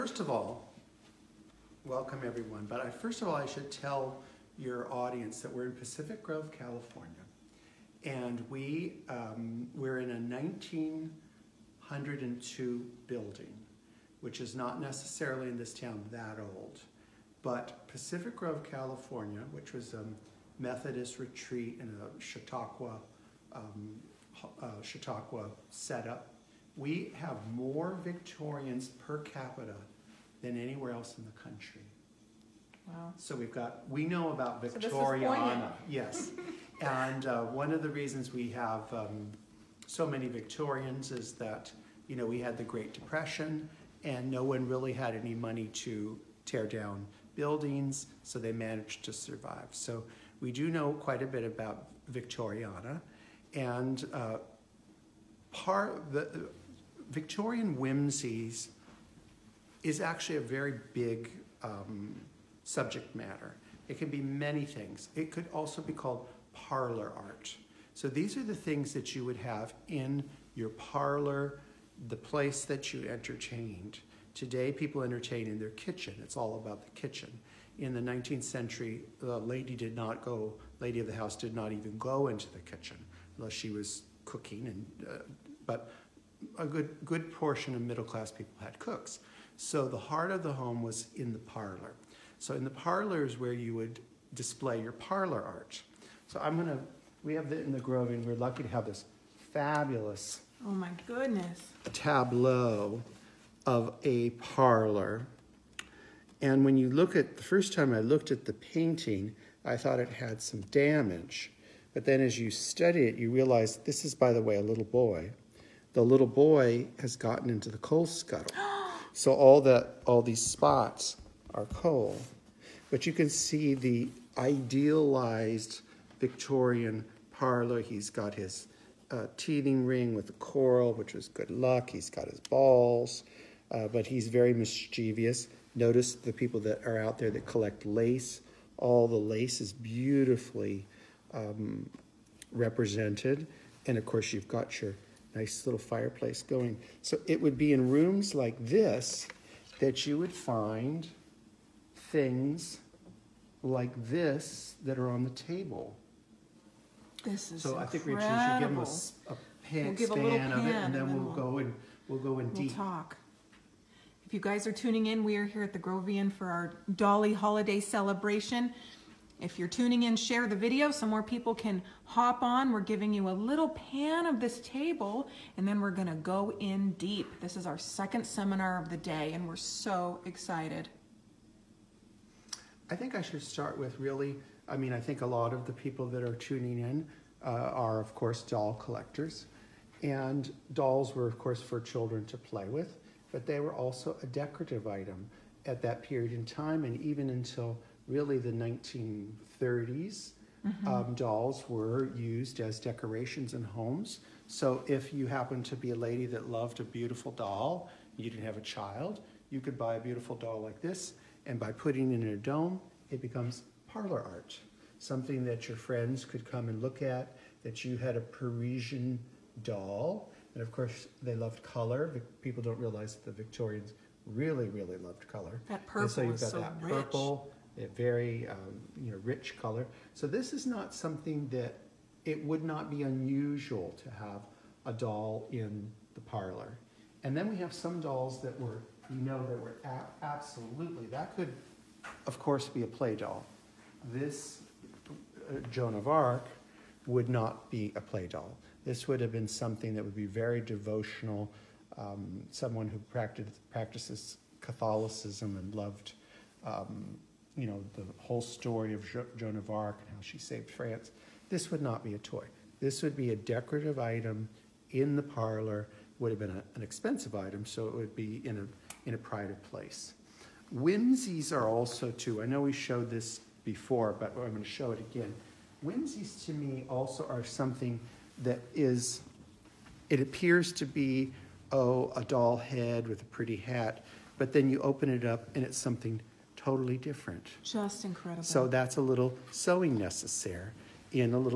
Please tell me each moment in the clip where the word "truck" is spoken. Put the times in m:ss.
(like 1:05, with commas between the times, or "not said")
not said.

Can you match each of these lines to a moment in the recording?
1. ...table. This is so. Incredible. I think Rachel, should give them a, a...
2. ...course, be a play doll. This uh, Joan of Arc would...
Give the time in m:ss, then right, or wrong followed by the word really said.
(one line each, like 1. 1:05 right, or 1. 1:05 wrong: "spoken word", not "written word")
1. 2:35 right
2. 4:02 right.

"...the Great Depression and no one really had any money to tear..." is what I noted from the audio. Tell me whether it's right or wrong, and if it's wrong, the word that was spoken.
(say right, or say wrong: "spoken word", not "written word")
right.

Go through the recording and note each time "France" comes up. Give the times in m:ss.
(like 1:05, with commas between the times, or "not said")
4:20.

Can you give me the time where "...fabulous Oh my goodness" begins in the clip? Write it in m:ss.
1:39.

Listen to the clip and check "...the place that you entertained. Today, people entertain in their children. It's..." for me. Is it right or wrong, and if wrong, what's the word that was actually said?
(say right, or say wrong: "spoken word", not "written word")
wrong: "kitchen", not "children".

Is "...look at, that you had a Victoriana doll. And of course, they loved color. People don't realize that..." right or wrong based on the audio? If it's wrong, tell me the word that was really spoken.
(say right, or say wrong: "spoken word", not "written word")
wrong: "Parisian", not "Victoriana".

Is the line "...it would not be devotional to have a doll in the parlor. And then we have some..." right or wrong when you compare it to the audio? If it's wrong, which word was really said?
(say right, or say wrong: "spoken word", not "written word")
wrong: "unusual", not "devotional".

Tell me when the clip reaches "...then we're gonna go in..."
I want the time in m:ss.
2:55.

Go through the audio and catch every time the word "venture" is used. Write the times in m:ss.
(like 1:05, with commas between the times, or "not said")
not said.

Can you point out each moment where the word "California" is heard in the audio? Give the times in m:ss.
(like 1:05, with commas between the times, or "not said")
0:06, 0:18.